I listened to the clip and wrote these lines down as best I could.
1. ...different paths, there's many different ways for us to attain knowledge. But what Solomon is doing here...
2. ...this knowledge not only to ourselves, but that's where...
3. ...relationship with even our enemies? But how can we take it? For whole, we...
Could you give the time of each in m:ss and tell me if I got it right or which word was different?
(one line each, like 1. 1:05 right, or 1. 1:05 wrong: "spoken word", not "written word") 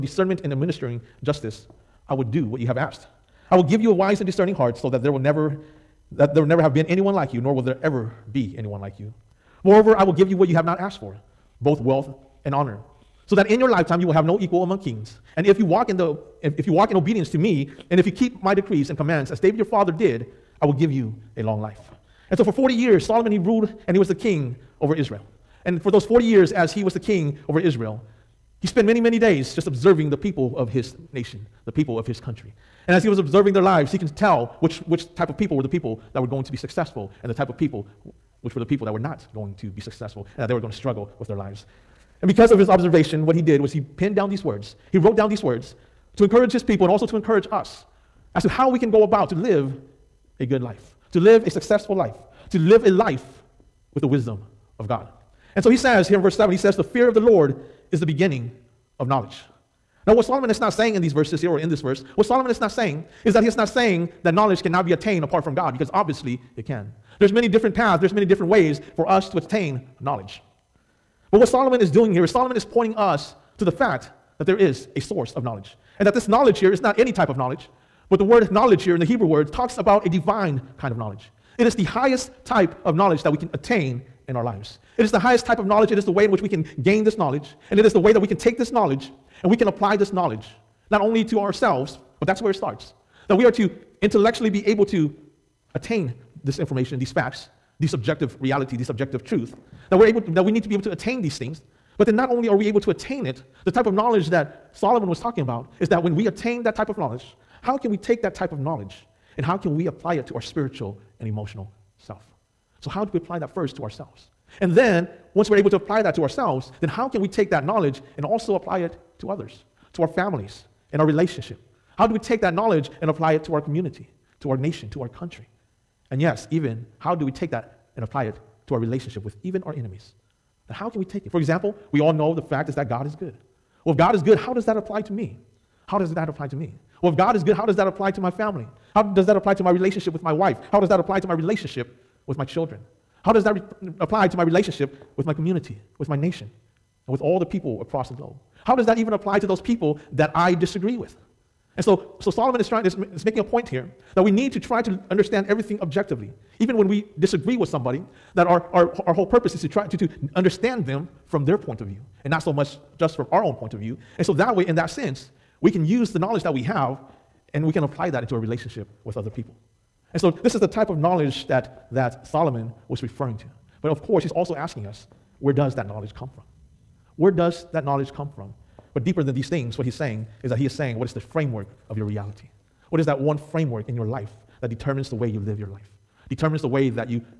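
1. 1:07 right
2. 1:29 right
3. 2:08 wrong: "example", not "whole".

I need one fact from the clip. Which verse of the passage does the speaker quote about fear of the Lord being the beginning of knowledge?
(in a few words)
Verse 7.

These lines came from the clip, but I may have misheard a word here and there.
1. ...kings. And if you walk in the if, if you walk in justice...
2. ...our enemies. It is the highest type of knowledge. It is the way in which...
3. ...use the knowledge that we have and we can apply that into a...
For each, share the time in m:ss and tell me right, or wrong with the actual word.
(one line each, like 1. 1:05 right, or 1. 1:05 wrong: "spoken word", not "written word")
1. 0:14 wrong: "obedience", not "justice"
2. 1:24 wrong: "lives", not "enemies"
3. 2:45 right.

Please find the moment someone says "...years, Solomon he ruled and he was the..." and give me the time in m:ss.
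0:22.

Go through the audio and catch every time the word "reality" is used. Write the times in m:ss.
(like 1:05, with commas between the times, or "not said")
1:38, 3:02.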